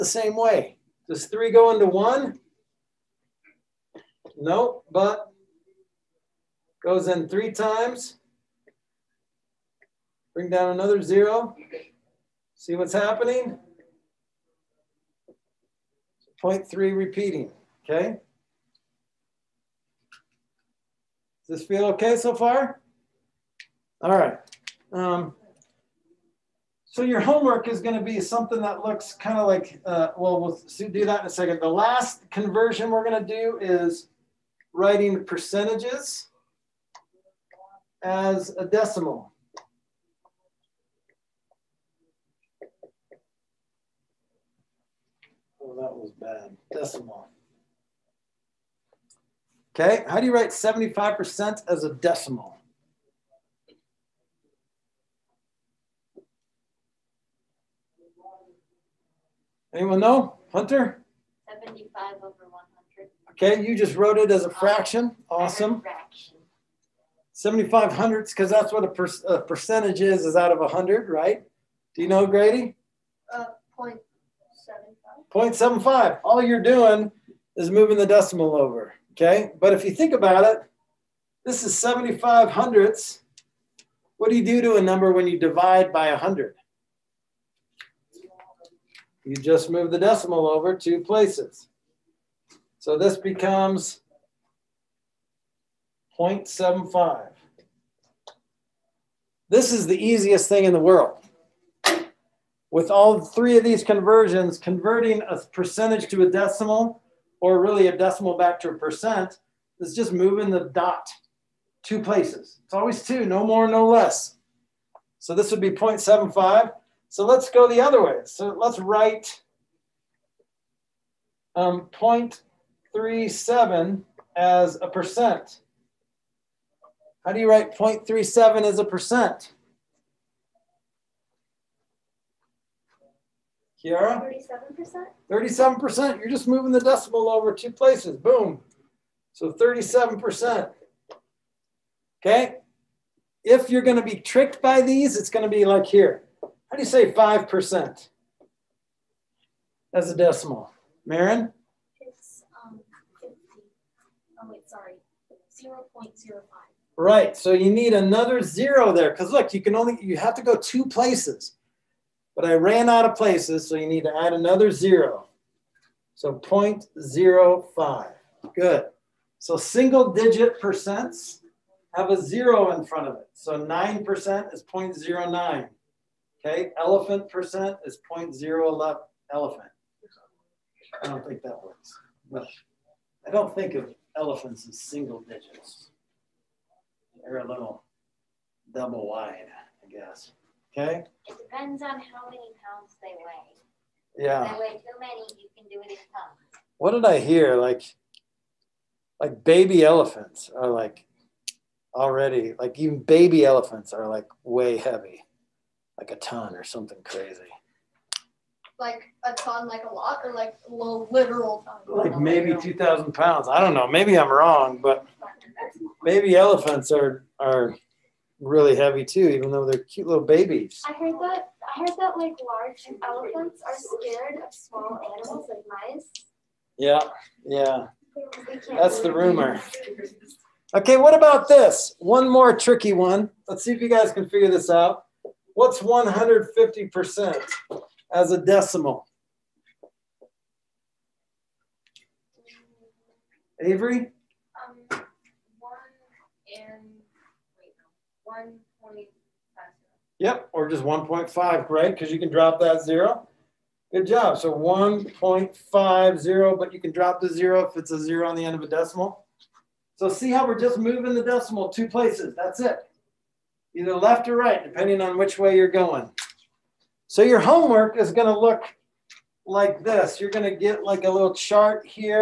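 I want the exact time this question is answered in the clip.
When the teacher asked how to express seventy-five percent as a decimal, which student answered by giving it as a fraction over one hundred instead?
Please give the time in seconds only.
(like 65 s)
60 s.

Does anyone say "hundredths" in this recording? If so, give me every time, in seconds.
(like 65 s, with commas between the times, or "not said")
67 s, 82 s.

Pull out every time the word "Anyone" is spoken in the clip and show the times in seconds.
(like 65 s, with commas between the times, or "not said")
59 s.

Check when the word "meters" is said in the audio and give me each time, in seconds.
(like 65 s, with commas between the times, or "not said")
not said.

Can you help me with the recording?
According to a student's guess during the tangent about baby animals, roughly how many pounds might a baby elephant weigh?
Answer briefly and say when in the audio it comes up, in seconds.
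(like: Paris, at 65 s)
2000, at 212 s.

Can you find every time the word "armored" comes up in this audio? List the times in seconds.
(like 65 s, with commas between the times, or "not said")
not said.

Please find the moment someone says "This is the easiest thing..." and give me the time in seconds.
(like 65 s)
99 s.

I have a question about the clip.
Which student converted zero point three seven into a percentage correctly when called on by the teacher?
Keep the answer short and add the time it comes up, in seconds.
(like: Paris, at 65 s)
Kiara, at 133 s.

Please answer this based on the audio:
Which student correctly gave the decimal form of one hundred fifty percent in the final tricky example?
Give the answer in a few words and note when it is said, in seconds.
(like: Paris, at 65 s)
Avery, at 243 s.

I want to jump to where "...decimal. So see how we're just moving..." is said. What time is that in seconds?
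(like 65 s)
258 s.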